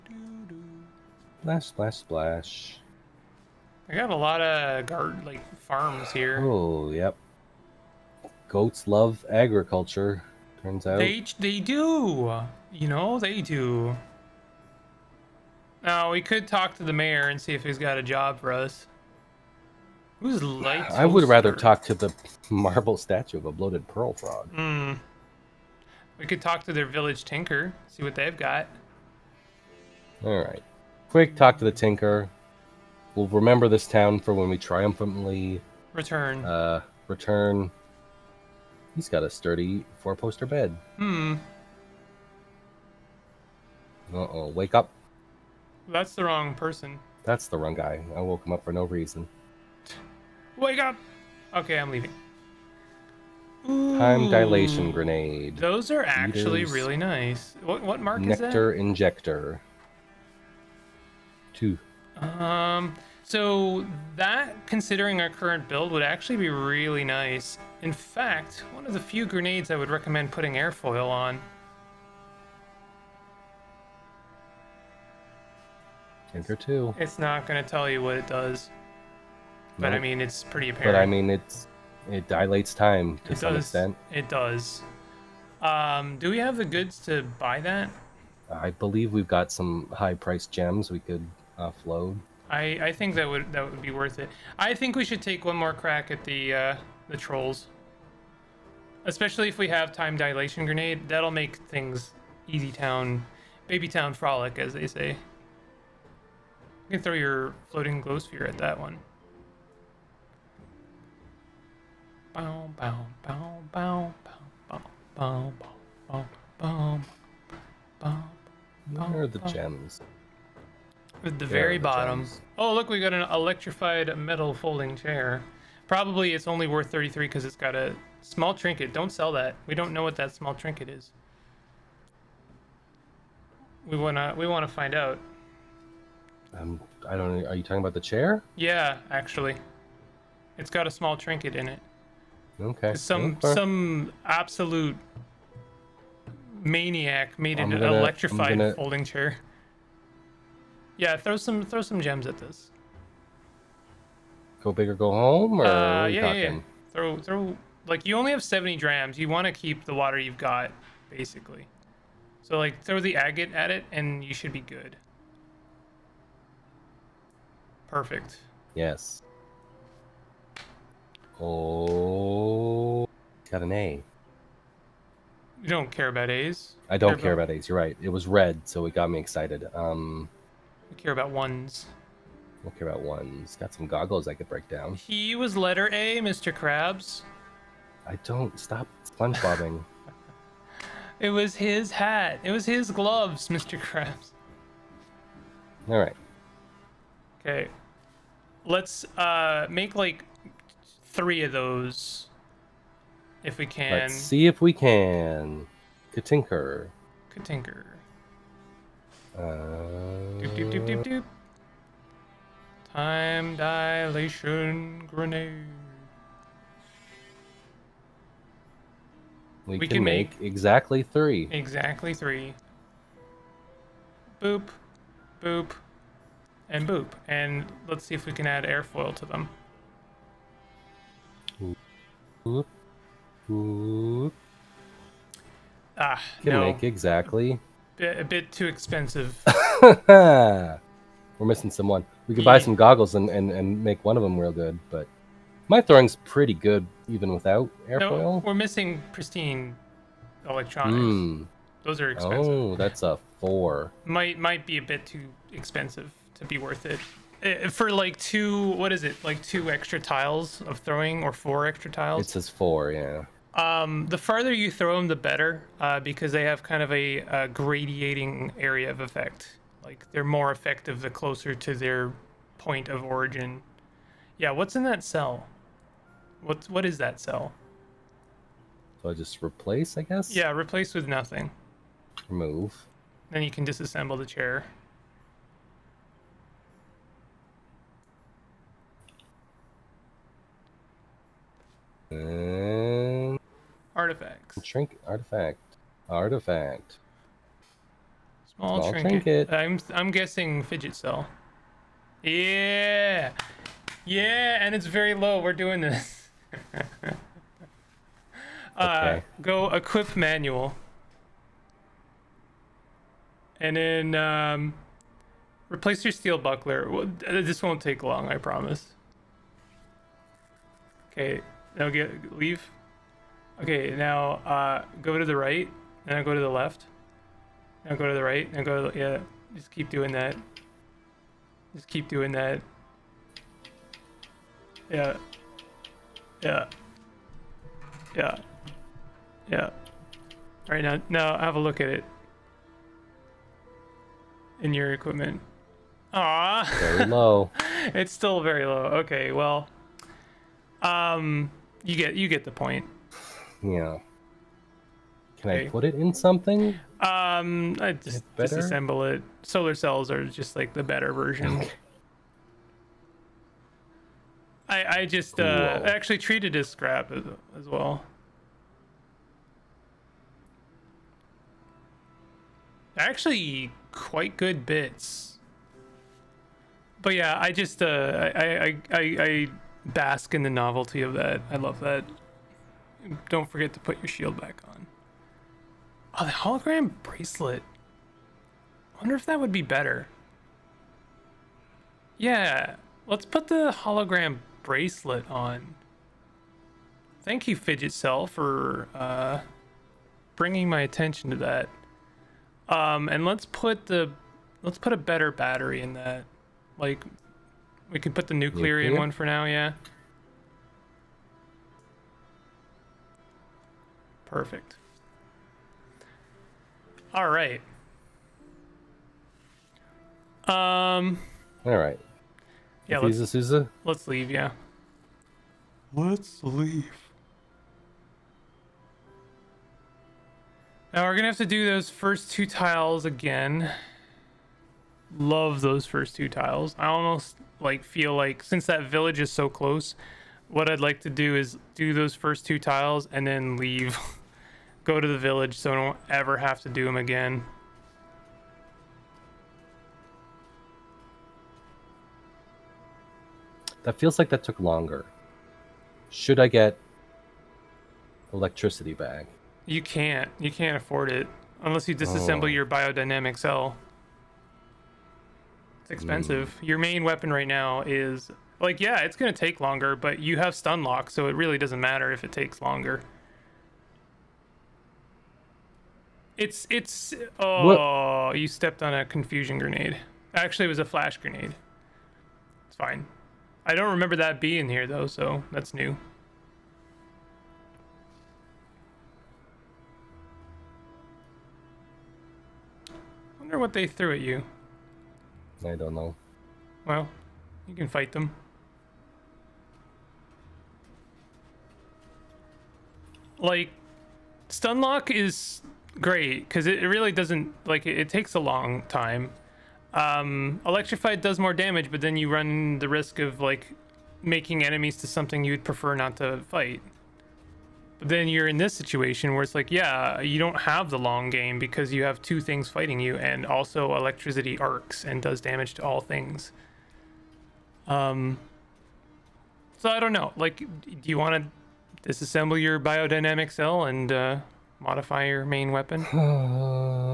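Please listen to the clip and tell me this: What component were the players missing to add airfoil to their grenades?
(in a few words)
Pristine electronics.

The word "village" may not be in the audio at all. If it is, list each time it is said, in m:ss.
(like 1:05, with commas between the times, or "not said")
0:26, 7:18, 7:25.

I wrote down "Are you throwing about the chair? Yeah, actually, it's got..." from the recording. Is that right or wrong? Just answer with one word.
wrong.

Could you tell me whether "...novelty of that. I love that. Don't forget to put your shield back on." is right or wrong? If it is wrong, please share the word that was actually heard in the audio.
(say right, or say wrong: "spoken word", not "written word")
right.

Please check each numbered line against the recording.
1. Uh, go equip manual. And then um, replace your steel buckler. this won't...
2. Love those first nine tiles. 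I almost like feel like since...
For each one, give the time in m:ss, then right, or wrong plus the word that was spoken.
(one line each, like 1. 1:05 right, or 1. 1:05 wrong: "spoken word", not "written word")
1. 5:09 right
2. 7:15 wrong: "two", not "nine".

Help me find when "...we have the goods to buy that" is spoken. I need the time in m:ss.
1:26.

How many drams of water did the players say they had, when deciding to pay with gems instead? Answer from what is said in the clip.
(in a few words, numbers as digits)
70.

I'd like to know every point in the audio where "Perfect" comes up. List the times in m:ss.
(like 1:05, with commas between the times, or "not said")
2:47, 6:54.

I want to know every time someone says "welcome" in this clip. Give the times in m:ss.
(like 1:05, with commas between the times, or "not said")
not said.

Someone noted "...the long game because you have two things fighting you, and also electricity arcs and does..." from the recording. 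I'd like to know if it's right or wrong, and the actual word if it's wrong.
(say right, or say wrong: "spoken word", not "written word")
right.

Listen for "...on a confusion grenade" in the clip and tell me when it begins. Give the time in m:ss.
7:58.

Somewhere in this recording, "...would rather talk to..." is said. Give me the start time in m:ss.
0:21.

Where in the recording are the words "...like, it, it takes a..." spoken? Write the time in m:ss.
8:27.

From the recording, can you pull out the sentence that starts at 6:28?
I wonder if that would be better.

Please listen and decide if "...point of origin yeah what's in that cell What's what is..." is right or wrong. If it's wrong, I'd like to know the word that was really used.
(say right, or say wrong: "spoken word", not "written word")
right.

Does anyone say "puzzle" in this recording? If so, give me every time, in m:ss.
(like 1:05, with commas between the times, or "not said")
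not said.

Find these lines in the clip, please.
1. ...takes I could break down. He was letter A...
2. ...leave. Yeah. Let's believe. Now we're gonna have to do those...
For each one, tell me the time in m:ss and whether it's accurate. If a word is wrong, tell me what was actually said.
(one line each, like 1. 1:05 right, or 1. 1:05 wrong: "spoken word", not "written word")
1. 3:03 wrong: "goggles", not "takes"
2. 7:04 wrong: "leave", not "believe".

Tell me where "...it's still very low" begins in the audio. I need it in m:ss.
5:47.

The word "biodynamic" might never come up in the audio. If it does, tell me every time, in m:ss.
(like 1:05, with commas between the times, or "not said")
7:42, 8:52.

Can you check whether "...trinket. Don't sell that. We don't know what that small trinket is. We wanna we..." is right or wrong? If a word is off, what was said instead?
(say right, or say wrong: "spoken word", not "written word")
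right.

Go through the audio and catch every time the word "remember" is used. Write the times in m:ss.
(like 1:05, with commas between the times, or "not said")
0:33, 8:03.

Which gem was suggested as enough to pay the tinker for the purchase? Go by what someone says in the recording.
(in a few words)
Agate.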